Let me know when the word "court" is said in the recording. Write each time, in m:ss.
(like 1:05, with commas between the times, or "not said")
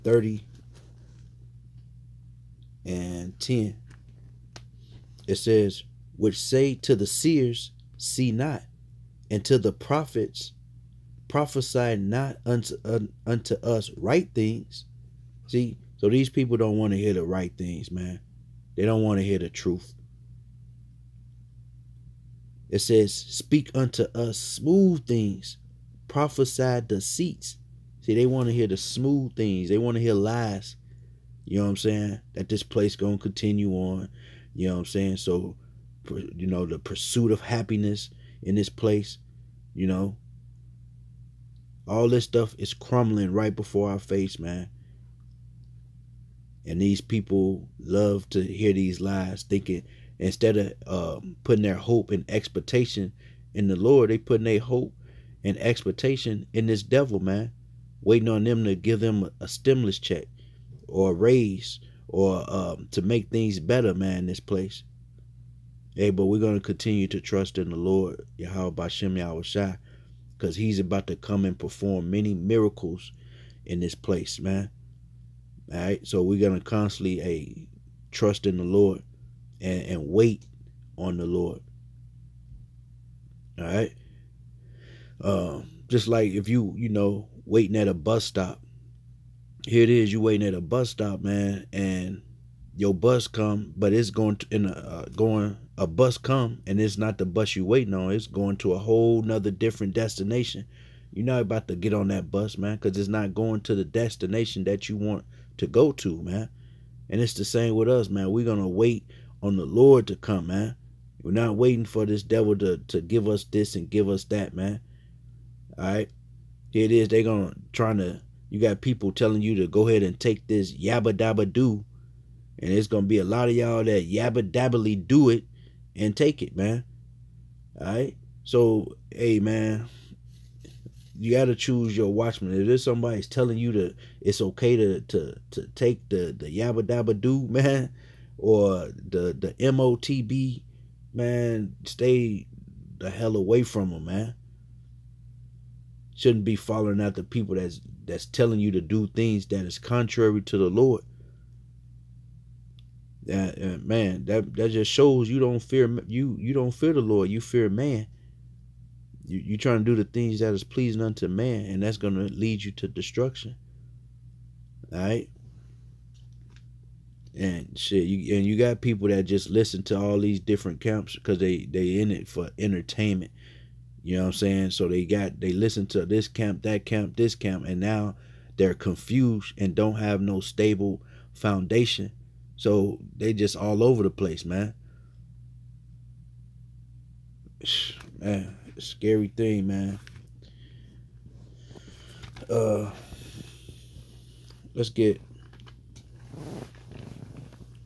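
not said.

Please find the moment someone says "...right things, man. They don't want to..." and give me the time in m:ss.
0:17.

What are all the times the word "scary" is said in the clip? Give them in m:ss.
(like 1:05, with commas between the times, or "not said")
3:08.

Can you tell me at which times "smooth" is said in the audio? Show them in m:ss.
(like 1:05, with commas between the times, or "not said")
0:24, 0:28.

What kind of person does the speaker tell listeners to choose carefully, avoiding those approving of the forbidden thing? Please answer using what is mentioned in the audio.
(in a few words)
watchman.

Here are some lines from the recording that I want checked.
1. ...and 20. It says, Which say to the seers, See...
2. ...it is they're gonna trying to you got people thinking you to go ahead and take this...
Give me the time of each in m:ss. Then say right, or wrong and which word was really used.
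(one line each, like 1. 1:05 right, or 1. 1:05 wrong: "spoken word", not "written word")
1. 0:02 wrong: "10", not "20"
2. 1:56 wrong: "telling", not "thinking".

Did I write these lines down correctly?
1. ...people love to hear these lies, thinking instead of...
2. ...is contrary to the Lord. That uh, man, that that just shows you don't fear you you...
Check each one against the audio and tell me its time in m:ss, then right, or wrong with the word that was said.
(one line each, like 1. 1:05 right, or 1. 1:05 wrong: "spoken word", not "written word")
1. 0:46 right
2. 2:29 right.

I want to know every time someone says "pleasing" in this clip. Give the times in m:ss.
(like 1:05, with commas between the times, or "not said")
2:40.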